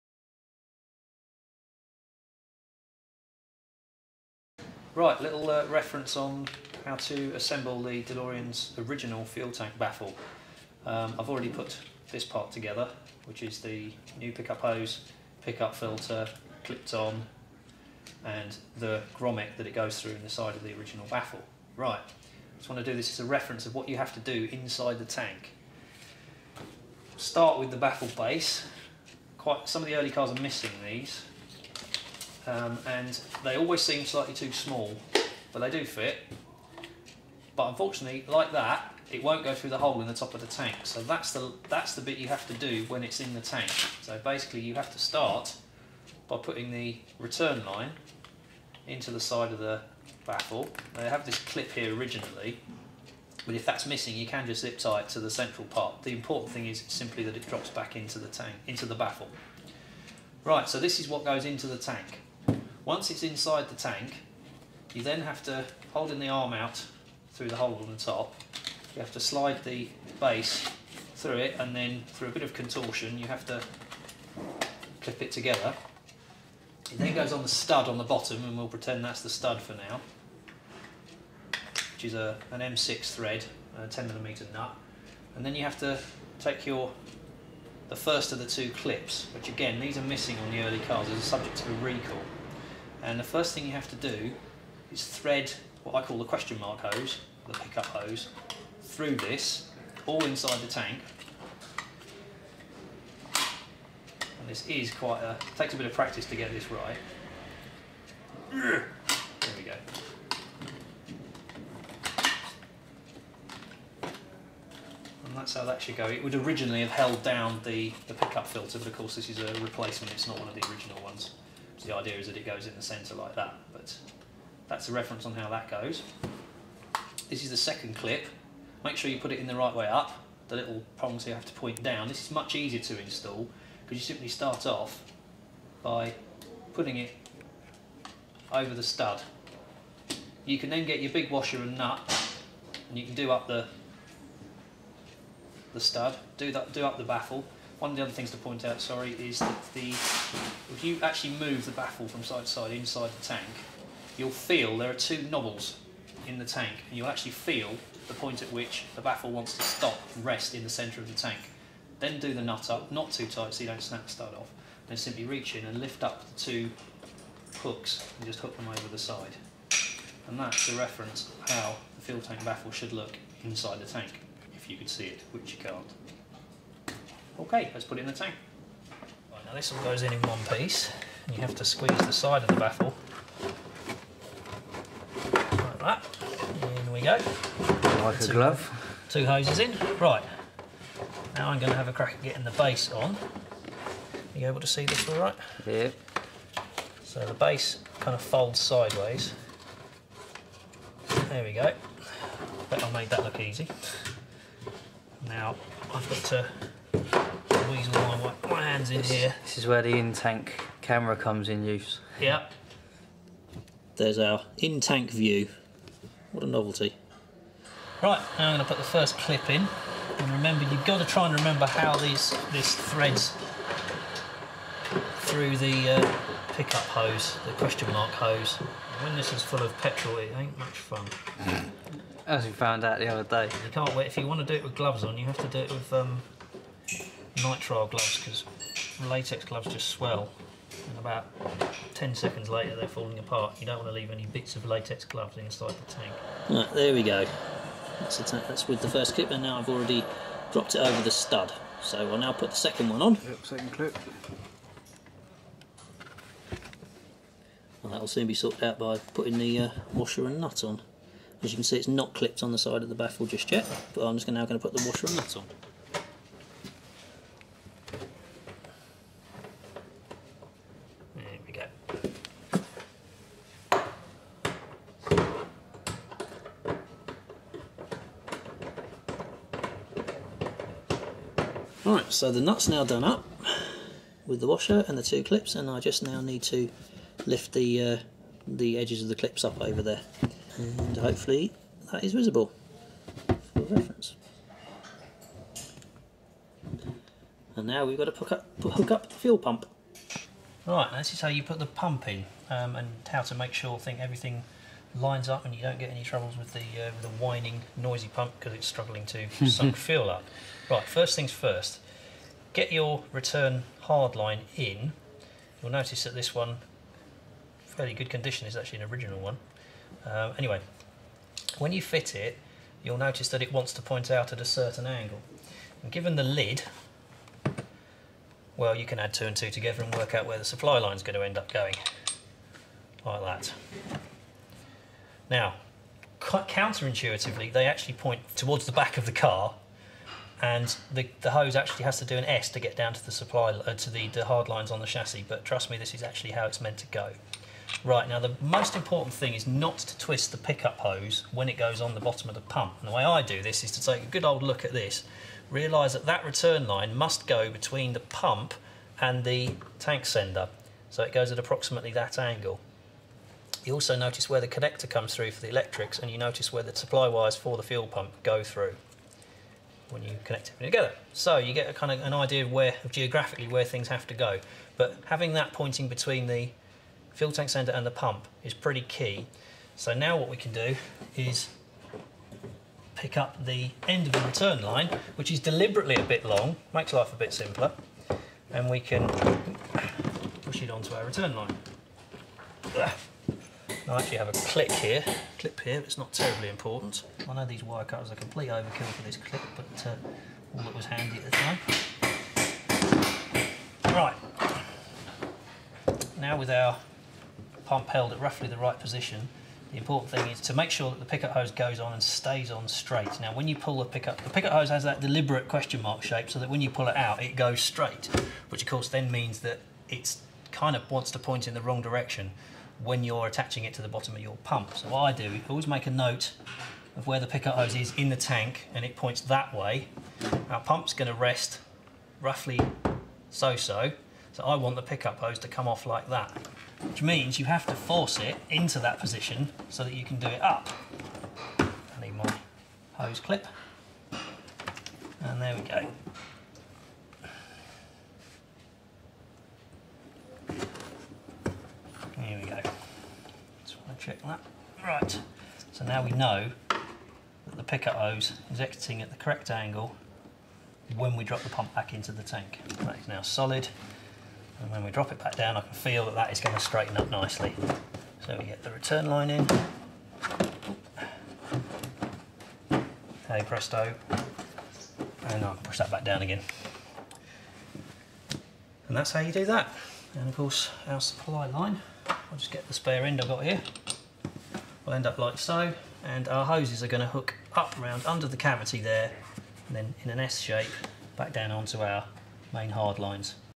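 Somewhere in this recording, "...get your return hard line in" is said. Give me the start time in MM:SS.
05:12.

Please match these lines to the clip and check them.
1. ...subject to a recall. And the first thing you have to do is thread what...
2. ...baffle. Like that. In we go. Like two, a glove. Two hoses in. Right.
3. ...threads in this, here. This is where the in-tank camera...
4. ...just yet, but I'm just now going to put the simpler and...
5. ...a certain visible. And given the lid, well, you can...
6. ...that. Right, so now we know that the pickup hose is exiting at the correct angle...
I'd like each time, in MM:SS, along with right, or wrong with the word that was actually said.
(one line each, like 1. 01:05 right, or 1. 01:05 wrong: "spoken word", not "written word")
1. 01:31 right
2. 03:02 right
3. 03:28 wrong: "hands", not "threads"
4. 04:23 wrong: "washer", not "simpler"
5. 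05:24 wrong: "angle", not "visible"
6. 07:34 right.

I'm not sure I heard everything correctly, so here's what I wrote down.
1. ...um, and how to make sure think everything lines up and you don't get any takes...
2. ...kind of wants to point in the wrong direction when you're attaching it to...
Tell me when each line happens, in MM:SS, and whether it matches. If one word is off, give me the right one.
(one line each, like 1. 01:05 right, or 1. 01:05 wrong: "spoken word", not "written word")
1. 05:02 wrong: "troubles", not "takes"
2. 07:00 right.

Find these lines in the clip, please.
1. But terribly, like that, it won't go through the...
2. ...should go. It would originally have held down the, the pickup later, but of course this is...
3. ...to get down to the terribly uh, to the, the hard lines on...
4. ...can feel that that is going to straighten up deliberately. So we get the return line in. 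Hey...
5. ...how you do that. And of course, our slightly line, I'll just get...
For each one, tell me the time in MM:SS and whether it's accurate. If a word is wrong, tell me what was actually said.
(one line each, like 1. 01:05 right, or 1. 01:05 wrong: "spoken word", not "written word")
1. 00:37 wrong: "unfortunately", not "terribly"
2. 01:55 wrong: "filter", not "later"
3. 05:42 wrong: "supply", not "terribly"
4. 07:45 wrong: "nicely", not "deliberately"
5. 07:59 wrong: "supply", not "slightly".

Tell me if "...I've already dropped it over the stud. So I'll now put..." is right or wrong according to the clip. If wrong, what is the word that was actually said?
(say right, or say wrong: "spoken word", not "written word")
right.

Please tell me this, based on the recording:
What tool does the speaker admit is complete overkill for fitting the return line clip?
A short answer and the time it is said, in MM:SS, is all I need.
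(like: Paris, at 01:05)
Wire cutters, at 06:37.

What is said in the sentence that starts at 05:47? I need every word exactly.
Right now, the most important thing is not to twist the pickup hose when it goes on the bottom of the pump.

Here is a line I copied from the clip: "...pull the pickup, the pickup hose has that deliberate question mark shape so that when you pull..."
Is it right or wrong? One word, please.
right.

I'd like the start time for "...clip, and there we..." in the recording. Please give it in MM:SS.
07:23.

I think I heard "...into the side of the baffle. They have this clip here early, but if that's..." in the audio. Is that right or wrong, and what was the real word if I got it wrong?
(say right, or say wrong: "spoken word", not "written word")
wrong: "originally", not "early".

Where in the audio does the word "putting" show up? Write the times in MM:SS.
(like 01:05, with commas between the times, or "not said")
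00:46, 02:16, 04:19.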